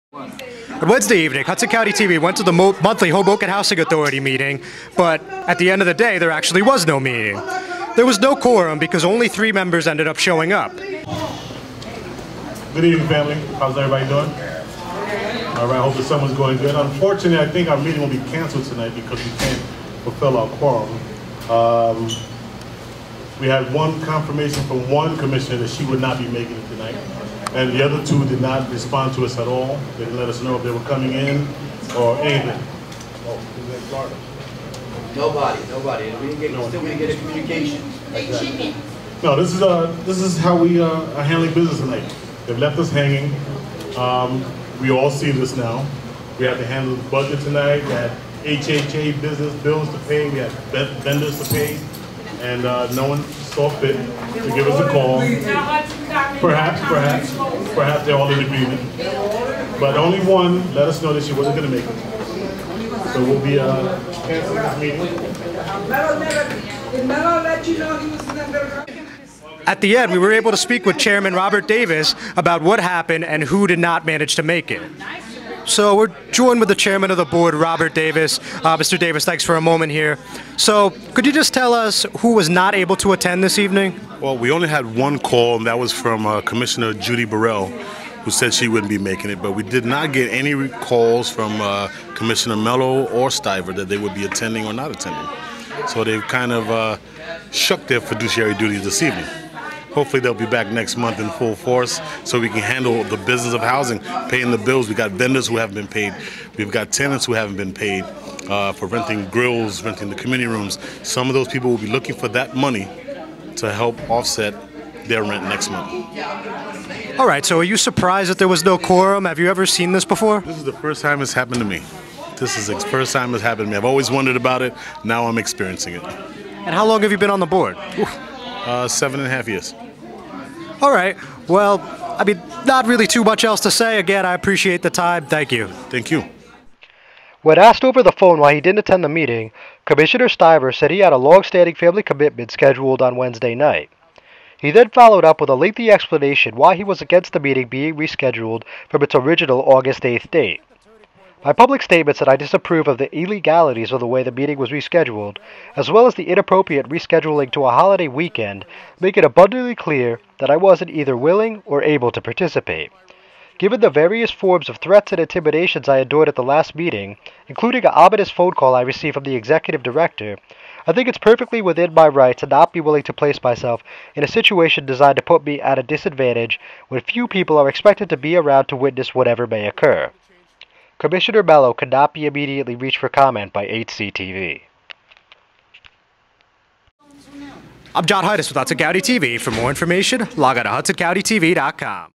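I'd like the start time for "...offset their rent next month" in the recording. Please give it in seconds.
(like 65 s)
114 s.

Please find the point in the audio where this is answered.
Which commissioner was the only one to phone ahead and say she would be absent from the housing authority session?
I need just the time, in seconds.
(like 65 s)
86 s.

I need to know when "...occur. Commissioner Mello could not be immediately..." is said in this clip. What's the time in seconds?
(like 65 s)
179 s.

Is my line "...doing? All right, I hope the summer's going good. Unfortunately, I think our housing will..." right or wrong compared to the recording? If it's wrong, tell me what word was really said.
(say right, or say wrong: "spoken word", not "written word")
wrong: "meeting", not "housing".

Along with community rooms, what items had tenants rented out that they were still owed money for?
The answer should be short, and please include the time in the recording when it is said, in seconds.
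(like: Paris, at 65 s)
Grills, at 109 s.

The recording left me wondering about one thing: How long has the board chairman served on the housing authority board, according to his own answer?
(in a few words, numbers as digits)
7.5 years.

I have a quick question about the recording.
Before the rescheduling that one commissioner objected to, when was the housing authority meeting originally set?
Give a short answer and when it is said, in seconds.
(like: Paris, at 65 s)
August 8, at 149 s.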